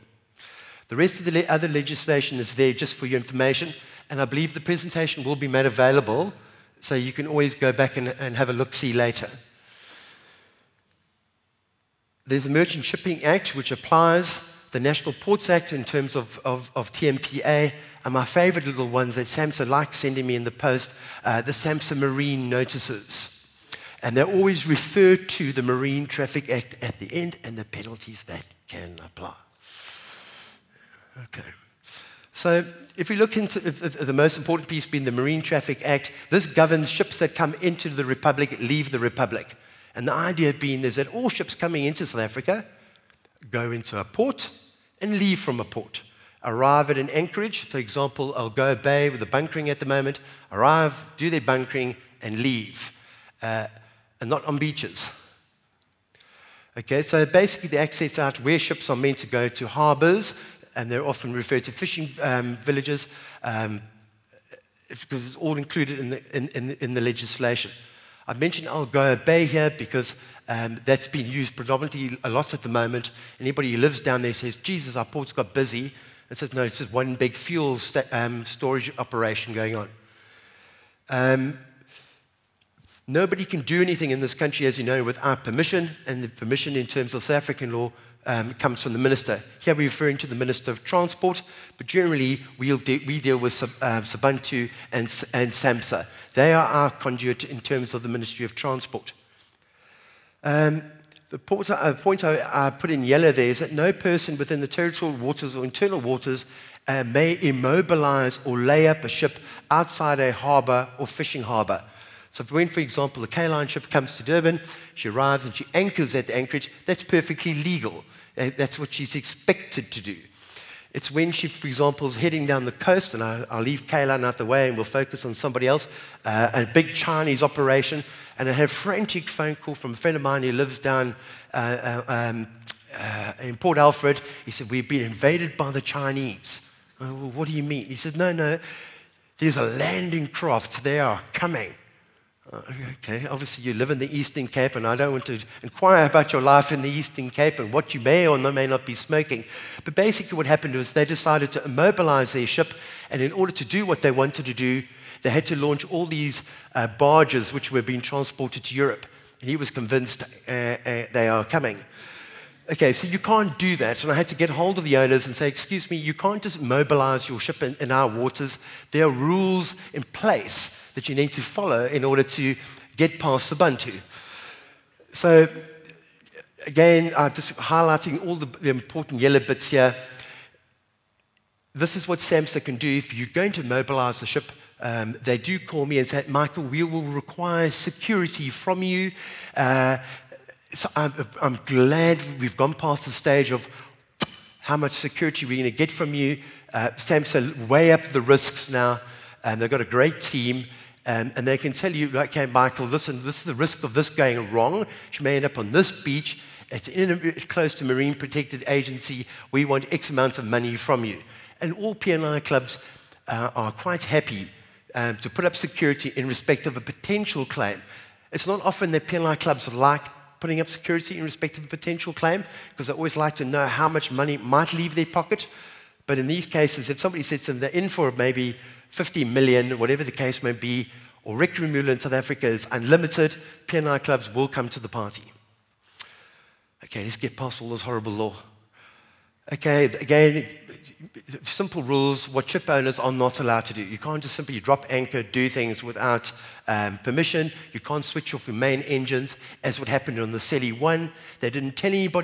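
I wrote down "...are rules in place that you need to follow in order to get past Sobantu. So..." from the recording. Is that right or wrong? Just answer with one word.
right.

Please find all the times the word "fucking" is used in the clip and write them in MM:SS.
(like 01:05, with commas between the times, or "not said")
not said.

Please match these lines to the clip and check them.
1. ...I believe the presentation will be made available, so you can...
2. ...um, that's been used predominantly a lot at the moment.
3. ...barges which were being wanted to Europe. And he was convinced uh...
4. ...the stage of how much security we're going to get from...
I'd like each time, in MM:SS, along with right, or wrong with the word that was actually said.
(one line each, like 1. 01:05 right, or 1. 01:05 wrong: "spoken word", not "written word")
1. 00:04 right
2. 01:10 right
3. 02:36 wrong: "transported", not "wanted"
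4. 03:13 right.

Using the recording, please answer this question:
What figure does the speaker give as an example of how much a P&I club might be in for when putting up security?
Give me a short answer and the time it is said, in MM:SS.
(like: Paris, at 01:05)
50 million, at 03:48.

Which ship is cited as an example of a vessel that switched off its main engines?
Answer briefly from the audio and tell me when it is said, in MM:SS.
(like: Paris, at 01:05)
Seli 1, at 04:10.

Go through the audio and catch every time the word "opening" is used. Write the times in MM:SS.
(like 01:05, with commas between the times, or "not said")
not said.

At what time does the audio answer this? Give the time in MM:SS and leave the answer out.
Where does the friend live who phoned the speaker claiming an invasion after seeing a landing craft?
02:13.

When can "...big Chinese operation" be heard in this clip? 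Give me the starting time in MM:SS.
02:06.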